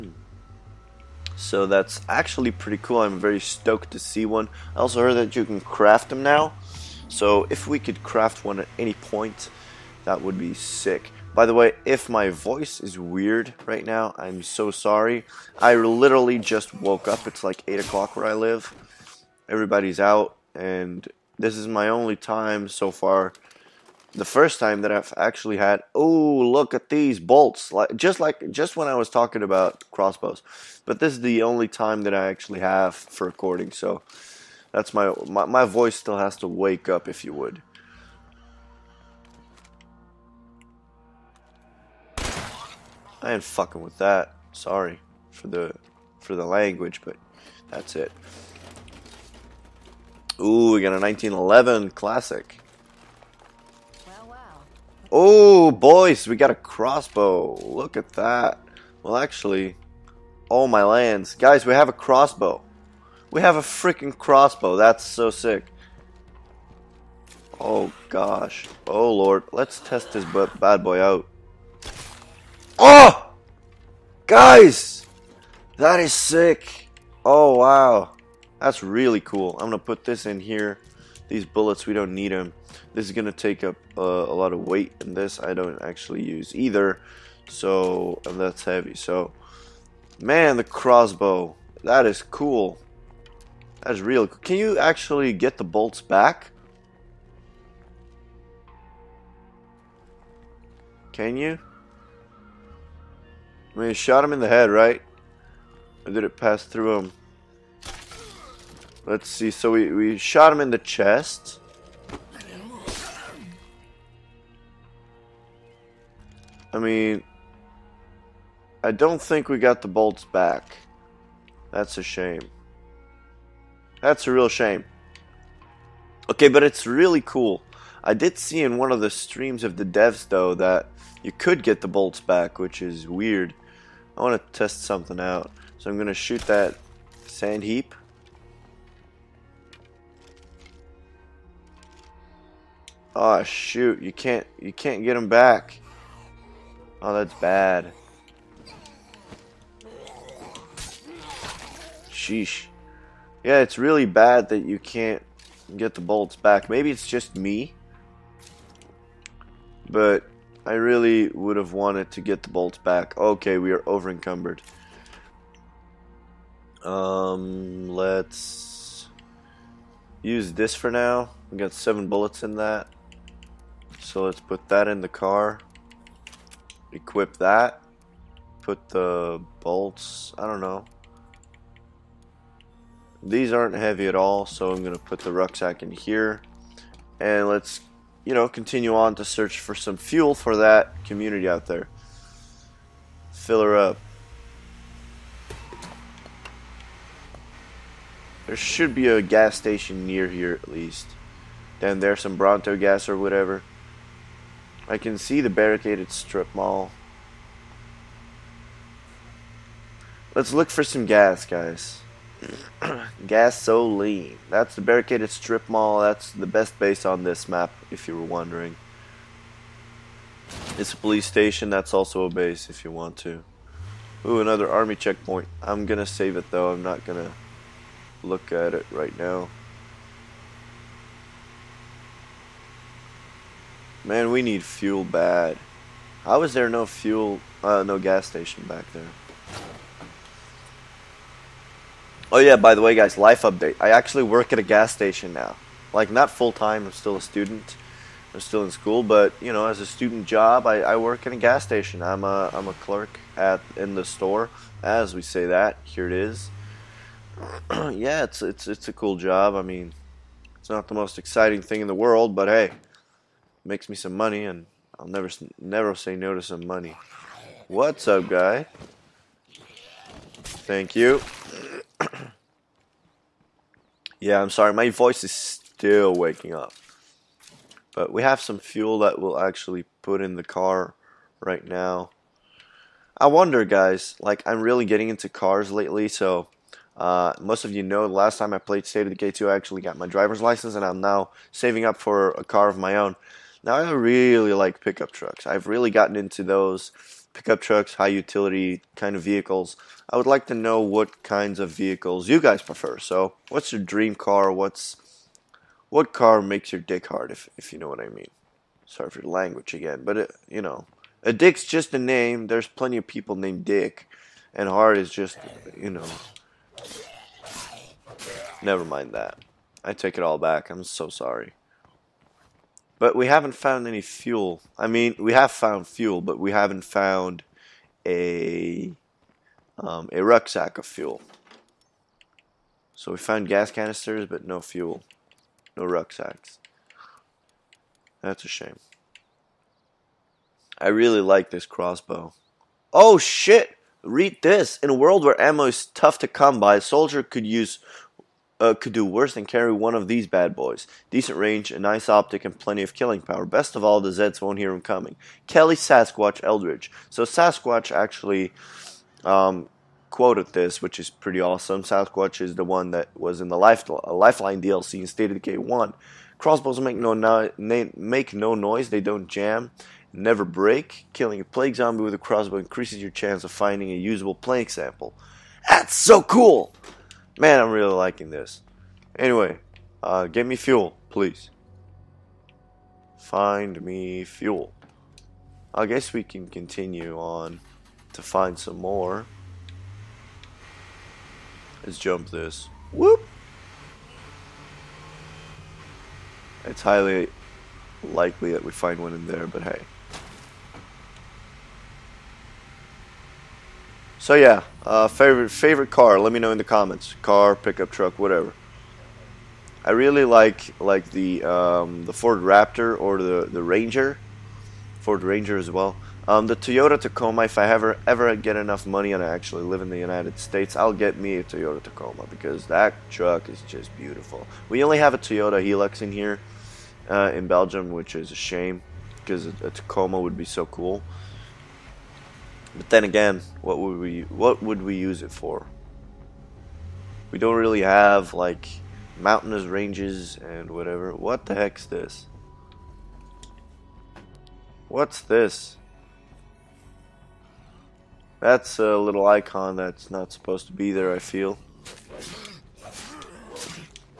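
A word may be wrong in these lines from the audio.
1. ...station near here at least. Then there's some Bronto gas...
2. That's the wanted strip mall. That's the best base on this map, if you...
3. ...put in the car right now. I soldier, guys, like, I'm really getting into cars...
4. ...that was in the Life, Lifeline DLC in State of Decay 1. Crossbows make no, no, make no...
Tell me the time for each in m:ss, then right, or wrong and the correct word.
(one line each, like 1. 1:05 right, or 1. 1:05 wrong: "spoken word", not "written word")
1. 3:19 right
2. 3:34 wrong: "barricaded", not "wanted"
3. 4:40 wrong: "wonder", not "soldier"
4. 6:02 right.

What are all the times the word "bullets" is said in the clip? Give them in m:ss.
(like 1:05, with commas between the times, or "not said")
1:21, 2:52.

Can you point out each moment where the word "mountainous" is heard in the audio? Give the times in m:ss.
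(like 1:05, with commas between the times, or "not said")
7:19.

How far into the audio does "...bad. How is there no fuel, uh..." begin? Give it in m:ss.
3:55.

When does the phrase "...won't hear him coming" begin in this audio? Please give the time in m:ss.
5:54.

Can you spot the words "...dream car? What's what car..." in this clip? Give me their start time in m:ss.
5:03.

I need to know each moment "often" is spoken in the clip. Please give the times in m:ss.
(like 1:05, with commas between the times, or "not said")
not said.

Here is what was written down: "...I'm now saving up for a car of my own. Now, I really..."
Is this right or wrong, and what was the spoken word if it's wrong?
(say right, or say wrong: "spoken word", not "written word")
right.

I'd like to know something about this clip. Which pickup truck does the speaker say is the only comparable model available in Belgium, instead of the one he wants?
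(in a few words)
Toyota Hilux.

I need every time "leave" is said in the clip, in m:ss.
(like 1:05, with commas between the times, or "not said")
not said.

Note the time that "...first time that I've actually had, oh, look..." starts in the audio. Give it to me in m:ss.
0:24.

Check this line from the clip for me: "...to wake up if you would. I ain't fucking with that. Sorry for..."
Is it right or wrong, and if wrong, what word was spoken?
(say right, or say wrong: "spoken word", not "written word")
right.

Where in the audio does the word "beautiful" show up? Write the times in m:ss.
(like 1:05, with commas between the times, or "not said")
7:03.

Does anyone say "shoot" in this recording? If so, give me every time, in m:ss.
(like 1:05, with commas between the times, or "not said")
2:16, 2:23.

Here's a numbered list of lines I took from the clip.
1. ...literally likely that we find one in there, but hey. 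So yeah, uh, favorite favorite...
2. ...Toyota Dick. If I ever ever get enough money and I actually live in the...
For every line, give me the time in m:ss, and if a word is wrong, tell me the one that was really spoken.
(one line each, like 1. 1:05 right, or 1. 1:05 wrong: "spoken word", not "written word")
1. 6:36 wrong: "highly", not "literally"
2. 6:56 wrong: "Tacoma", not "Dick".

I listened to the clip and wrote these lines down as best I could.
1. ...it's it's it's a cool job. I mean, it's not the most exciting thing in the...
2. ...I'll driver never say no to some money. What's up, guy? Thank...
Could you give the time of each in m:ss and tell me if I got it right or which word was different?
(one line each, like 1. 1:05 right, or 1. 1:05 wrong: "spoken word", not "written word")
1. 4:18 right
2. 4:24 wrong: "never", not "driver".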